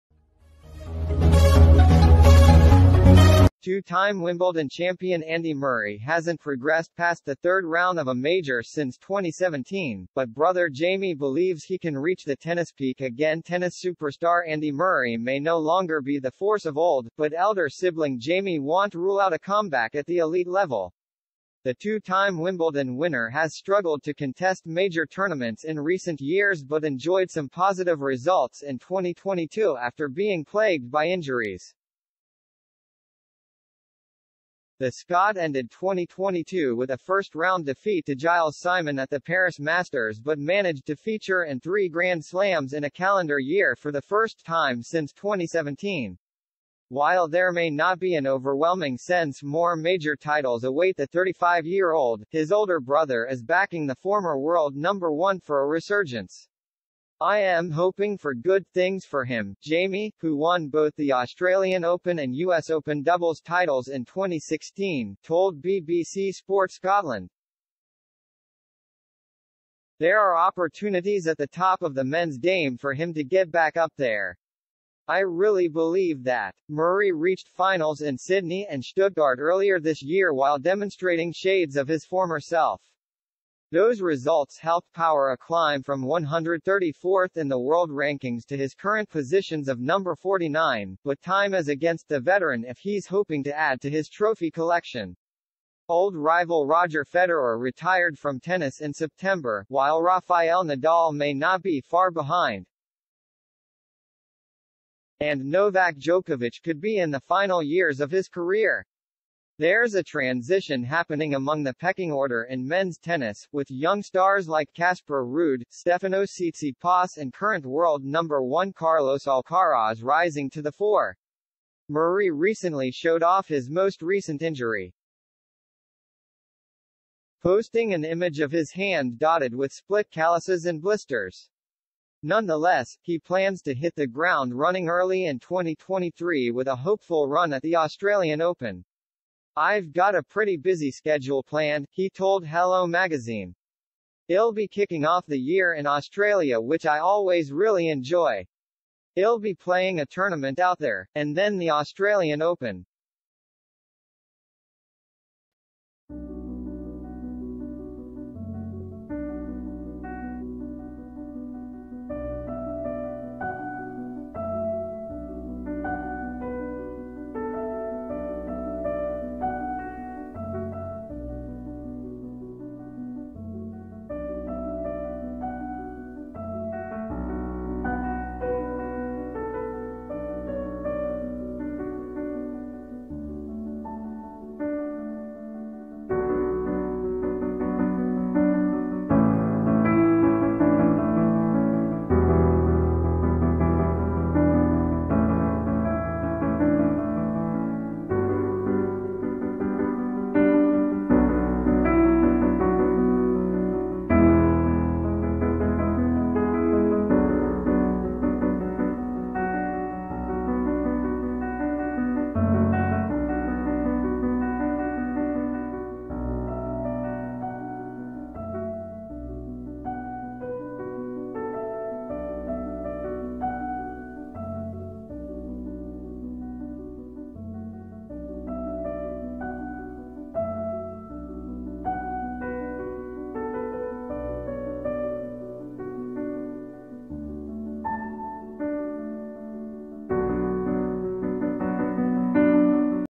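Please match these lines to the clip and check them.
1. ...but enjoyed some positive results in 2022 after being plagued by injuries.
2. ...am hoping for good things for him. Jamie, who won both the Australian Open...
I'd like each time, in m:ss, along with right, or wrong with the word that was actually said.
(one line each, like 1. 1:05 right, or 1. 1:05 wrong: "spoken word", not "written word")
1. 0:26 right
2. 0:57 right.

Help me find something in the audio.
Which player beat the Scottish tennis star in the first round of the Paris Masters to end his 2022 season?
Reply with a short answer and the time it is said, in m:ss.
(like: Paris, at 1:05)
Gilles Simon, at 0:38.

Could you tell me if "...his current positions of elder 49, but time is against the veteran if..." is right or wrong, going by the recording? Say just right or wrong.
wrong.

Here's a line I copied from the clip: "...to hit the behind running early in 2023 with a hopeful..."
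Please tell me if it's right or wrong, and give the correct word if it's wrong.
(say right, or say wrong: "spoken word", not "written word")
wrong: "ground", not "behind".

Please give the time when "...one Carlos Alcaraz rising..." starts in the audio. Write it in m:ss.
1:58.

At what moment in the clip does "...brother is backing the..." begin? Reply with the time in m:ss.
0:52.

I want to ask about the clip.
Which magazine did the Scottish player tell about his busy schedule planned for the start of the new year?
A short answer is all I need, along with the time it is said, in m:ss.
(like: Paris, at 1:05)
Hello Magazine, at 2:22.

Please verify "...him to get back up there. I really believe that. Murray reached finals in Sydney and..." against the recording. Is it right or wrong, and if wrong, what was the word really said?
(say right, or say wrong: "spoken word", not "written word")
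right.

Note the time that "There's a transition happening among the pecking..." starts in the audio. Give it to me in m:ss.
1:49.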